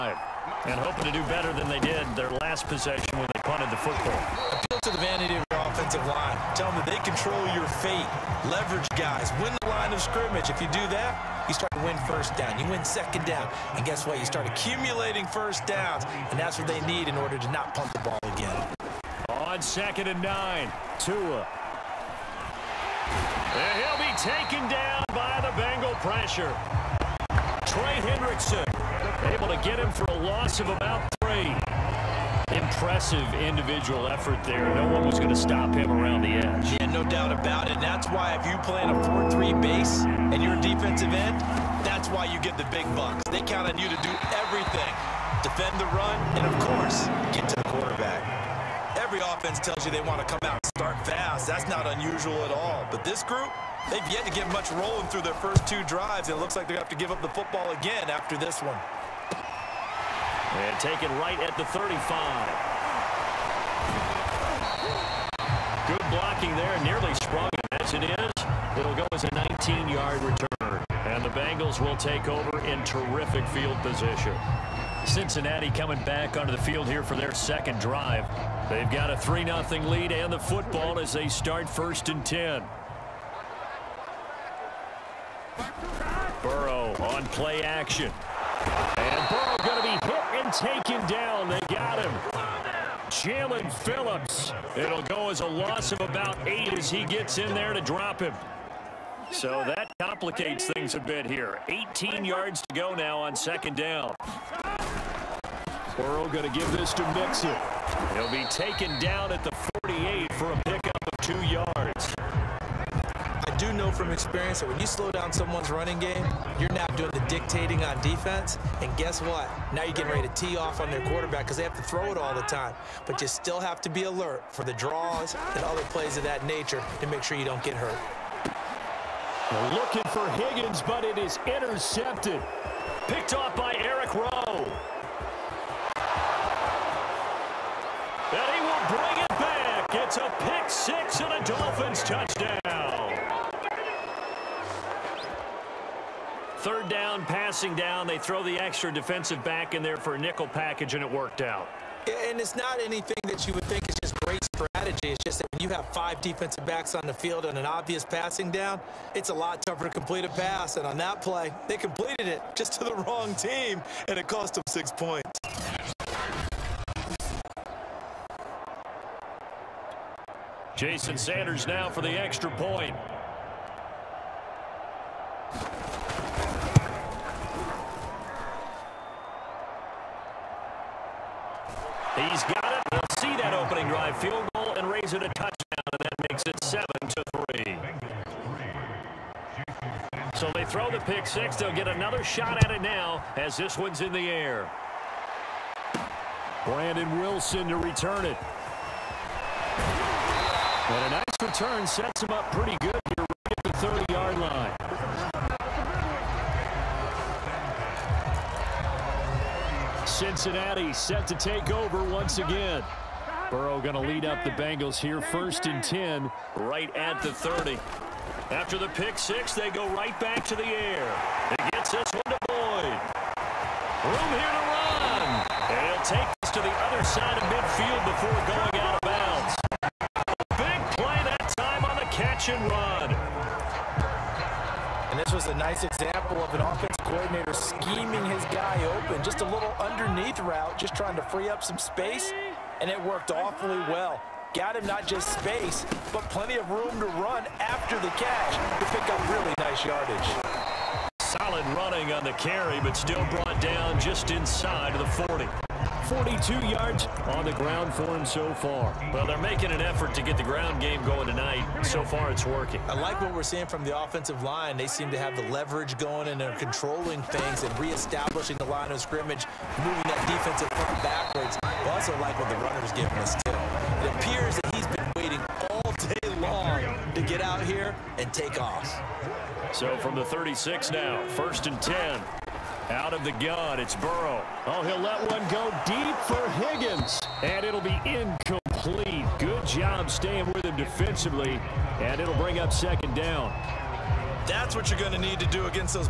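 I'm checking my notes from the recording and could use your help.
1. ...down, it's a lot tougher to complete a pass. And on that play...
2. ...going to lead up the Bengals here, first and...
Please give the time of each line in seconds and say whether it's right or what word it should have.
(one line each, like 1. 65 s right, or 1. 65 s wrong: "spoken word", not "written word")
1. 158 s right
2. 213 s right.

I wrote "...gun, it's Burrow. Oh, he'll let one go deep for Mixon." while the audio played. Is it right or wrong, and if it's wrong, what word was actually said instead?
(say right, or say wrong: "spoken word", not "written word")
wrong: "Higgins", not "Mixon".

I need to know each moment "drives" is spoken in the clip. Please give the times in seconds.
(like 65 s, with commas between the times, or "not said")
55 s, 77 s.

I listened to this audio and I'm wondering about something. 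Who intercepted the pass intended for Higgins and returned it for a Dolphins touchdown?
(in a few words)
Eric Rowe.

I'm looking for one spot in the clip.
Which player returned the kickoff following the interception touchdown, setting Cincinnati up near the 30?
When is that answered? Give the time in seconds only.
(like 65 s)
196 s.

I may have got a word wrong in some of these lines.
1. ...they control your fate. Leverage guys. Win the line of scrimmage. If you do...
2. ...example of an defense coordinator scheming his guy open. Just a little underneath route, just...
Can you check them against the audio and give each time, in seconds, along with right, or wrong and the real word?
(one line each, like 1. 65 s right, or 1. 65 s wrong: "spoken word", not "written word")
1. 6 s right
2. 235 s wrong: "offense", not "defense".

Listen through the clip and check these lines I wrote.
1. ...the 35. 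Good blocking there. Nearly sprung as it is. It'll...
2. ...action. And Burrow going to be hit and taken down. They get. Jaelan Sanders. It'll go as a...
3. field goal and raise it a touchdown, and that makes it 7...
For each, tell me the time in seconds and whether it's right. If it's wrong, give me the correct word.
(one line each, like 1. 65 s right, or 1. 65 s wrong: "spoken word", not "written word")
1. 61 s right
2. 87 s wrong: "Phillips", not "Sanders"
3. 184 s right.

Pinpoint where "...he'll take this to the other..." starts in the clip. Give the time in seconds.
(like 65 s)
225 s.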